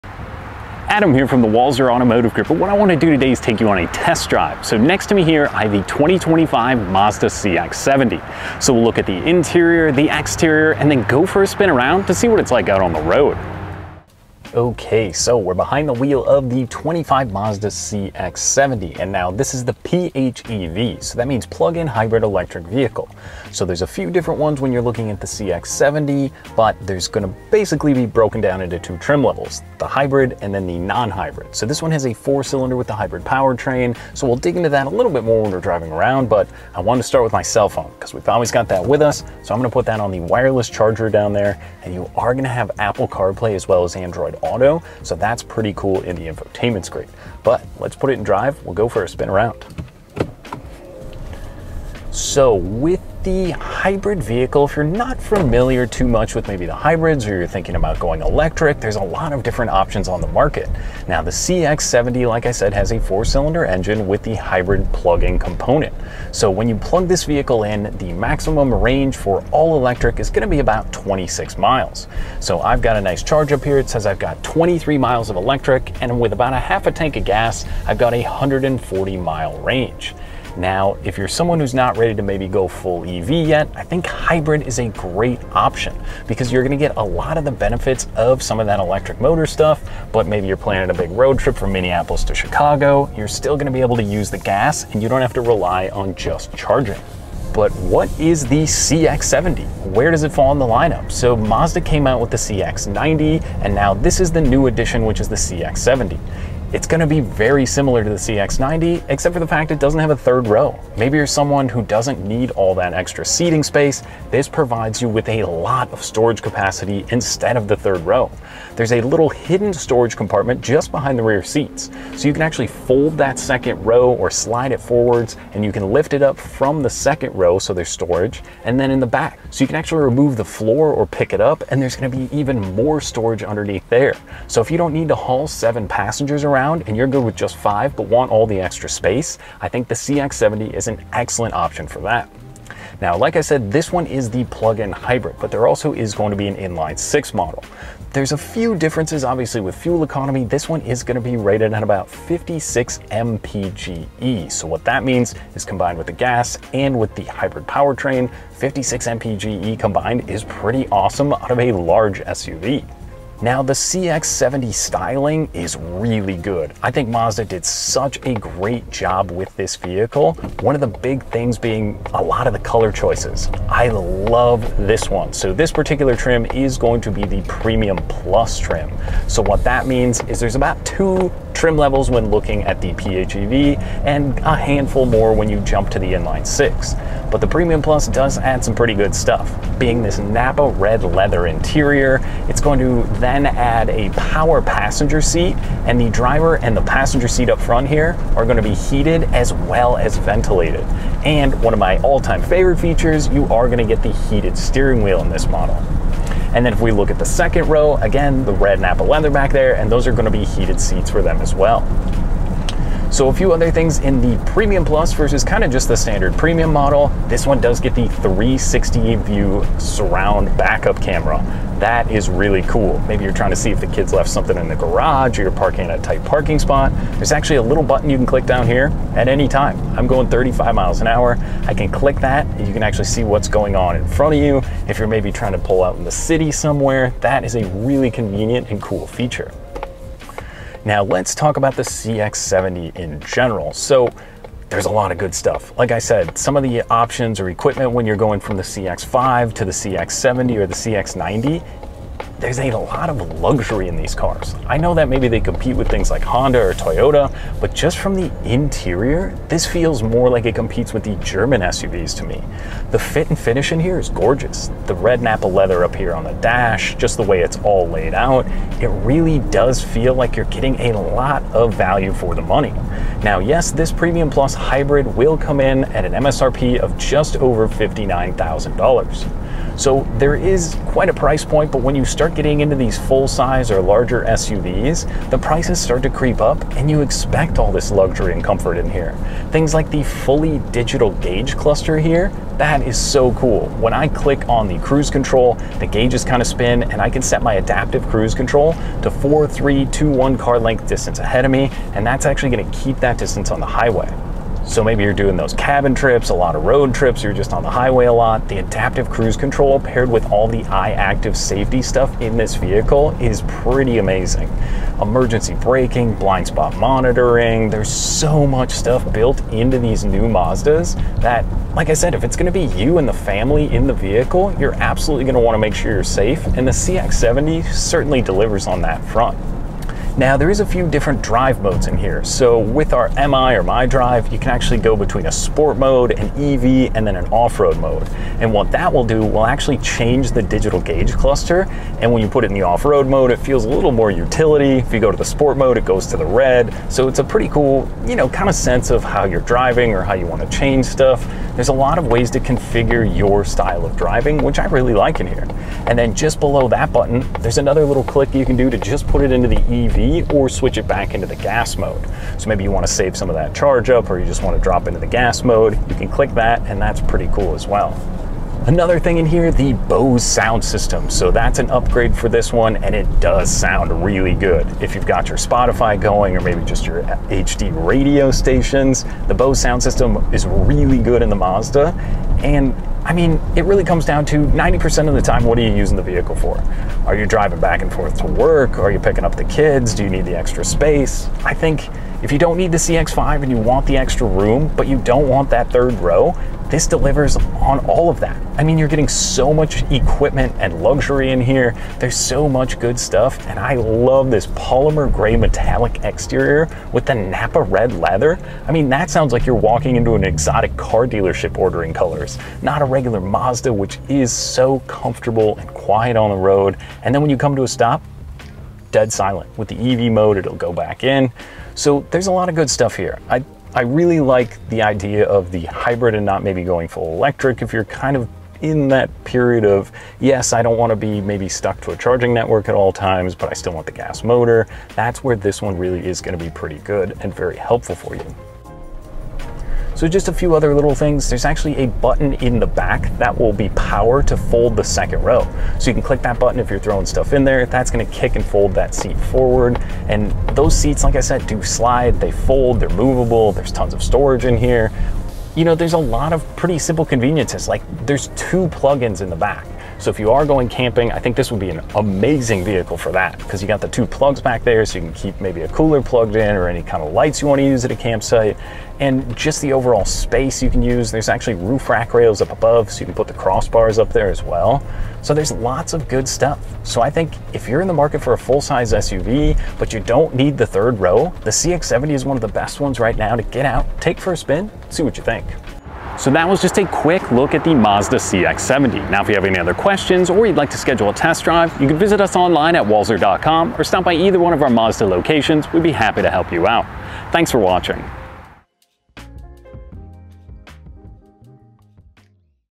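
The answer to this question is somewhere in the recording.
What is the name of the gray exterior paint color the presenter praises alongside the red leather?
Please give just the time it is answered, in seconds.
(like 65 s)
404 s.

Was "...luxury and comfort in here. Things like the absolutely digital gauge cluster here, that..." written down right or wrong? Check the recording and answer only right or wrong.
wrong.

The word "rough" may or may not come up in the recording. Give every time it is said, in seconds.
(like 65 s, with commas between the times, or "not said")
not said.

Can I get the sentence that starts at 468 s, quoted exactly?
And just the overall space you can use.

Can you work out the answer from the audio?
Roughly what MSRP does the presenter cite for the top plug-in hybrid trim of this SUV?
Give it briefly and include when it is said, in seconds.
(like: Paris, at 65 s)
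just over $59,000, at 276 s.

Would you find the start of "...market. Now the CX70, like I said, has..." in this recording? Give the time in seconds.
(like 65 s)
60 s.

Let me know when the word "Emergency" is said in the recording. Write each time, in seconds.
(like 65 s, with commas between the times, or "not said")
315 s.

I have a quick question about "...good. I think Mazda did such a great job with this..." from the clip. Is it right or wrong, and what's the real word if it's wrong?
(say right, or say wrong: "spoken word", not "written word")
right.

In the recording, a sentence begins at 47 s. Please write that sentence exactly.
But let's put it in drive, we'll go for a spin around.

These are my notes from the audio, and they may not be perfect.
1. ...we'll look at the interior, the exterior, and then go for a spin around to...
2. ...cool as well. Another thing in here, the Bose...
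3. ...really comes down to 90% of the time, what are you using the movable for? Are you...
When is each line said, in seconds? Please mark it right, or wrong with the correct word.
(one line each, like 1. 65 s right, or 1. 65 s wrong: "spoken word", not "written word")
1. 8 s right
2. 367 s right
3. 383 s wrong: "vehicle", not "movable".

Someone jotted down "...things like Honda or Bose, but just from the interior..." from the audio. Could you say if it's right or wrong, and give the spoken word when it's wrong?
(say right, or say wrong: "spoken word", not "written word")
wrong: "Toyota", not "Bose".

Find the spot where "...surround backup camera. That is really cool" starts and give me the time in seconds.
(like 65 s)
219 s.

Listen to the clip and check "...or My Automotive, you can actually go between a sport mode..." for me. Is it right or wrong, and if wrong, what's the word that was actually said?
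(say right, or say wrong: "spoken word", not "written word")
wrong: "Drive", not "Automotive".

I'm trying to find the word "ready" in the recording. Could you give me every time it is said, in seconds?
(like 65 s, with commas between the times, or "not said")
81 s.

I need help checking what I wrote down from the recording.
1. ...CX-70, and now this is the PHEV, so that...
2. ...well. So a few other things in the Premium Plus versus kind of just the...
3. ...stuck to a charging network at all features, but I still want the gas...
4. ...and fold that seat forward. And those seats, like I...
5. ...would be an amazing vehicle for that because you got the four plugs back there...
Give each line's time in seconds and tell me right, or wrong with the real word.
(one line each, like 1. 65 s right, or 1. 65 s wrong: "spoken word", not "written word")
1. 17 s right
2. 211 s right
3. 431 s wrong: "times", not "features"
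4. 448 s right
5. 461 s wrong: "two", not "four".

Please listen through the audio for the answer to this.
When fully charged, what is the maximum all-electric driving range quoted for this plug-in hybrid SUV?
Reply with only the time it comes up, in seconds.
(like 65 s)
70 s.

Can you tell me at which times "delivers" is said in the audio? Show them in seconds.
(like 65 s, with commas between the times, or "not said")
328 s, 396 s.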